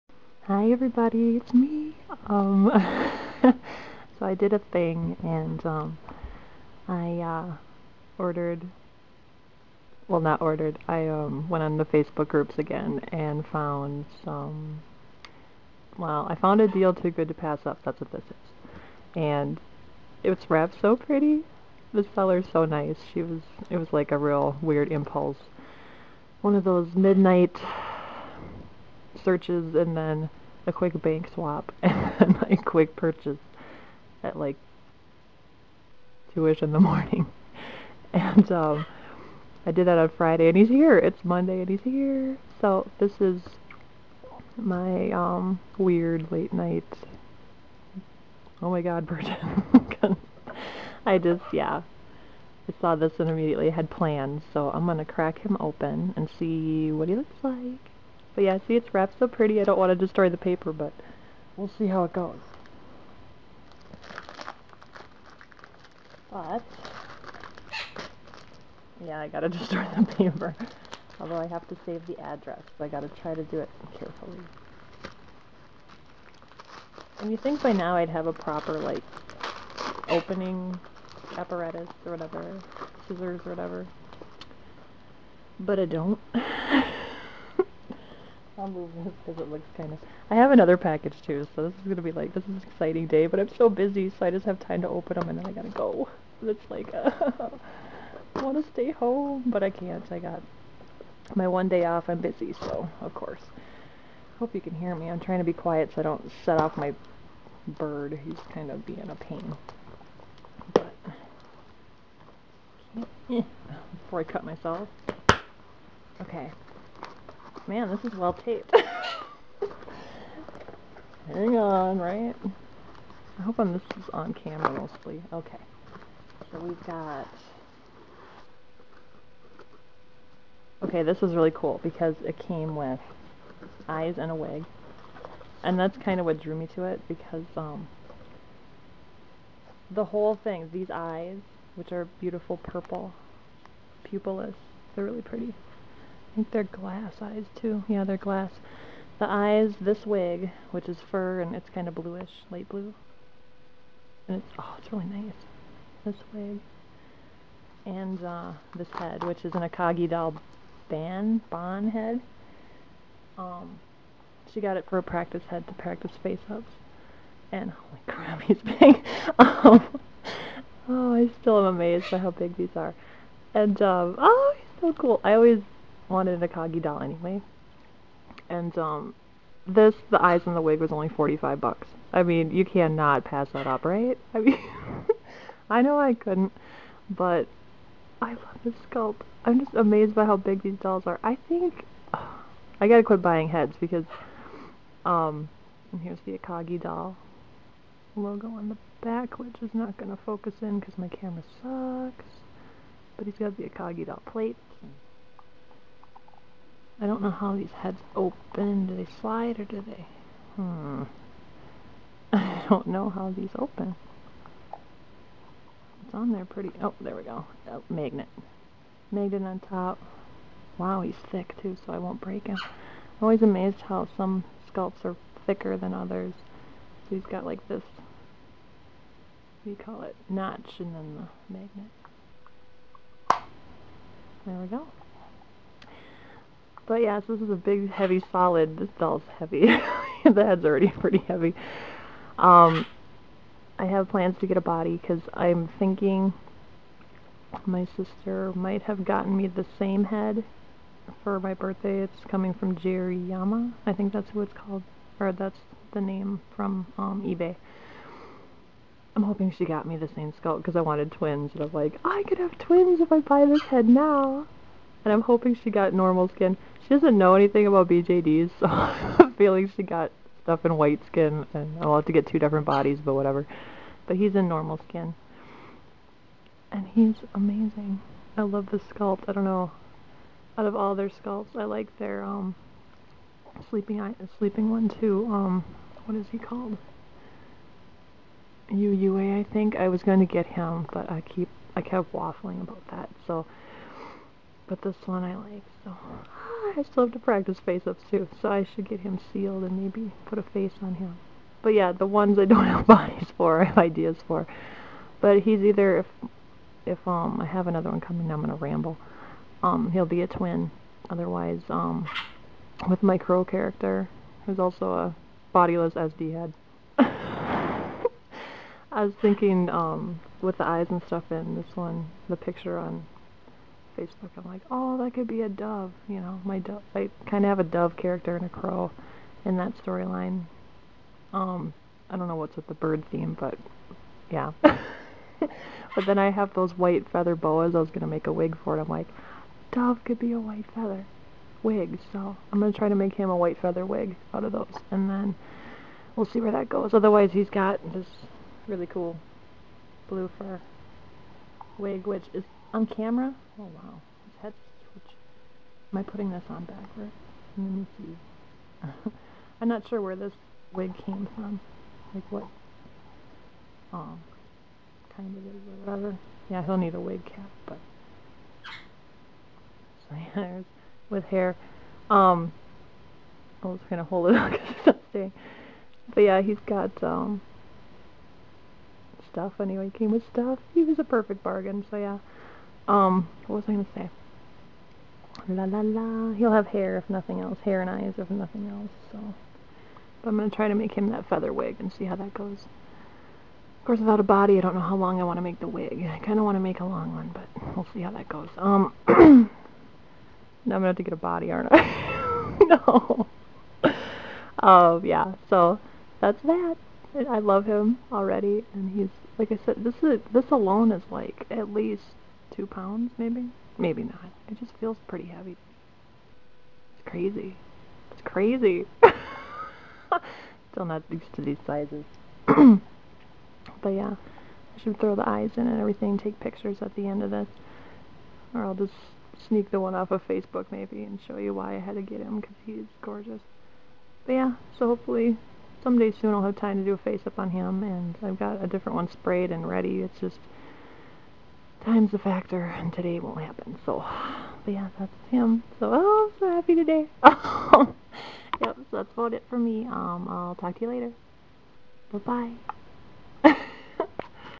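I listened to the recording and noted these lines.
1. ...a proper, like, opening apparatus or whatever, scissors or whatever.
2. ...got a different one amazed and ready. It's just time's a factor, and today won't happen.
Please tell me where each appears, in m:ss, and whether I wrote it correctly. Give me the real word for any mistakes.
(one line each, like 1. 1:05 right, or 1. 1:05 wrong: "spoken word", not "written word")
1. 1:18 right
2. 7:18 wrong: "sprayed", not "amazed".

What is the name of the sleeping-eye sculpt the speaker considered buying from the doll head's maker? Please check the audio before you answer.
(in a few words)
UUA.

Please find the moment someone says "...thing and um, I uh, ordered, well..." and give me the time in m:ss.
0:04.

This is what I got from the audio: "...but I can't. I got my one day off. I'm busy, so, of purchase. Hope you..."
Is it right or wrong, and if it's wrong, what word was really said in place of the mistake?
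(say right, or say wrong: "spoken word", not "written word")
wrong: "course", not "purchase".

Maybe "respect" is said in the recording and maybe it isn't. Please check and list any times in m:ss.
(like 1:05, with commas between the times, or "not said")
not said.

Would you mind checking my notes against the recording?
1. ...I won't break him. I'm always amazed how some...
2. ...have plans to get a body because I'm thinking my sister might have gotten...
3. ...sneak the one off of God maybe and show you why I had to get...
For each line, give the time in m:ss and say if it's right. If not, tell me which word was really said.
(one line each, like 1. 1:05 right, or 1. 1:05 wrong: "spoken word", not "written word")
1. 3:41 right
2. 4:03 right
3. 7:09 wrong: "Facebook", not "God".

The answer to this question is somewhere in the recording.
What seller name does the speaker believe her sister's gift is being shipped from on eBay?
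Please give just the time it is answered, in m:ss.
4:12.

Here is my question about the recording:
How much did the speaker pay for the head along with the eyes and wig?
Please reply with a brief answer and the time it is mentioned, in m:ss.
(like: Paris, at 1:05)
$45, at 3:01.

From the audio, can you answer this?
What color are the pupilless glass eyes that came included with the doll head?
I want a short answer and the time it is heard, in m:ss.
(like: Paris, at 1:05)
Purple, at 2:22.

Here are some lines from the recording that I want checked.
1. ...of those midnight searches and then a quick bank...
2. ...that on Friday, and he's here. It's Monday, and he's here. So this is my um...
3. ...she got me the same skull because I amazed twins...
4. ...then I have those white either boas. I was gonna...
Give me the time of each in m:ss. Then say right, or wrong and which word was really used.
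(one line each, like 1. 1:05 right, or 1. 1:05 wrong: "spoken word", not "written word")
1. 0:26 right
2. 0:39 right
3. 4:19 wrong: "wanted", not "amazed"
4. 5:36 wrong: "feather", not "either".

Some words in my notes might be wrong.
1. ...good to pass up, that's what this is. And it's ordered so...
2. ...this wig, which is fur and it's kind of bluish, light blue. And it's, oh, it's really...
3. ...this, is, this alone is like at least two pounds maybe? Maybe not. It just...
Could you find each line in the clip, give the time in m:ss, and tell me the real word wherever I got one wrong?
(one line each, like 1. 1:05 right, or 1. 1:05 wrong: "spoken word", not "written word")
1. 0:17 wrong: "wrapped", not "ordered"
2. 2:29 right
3. 6:49 right.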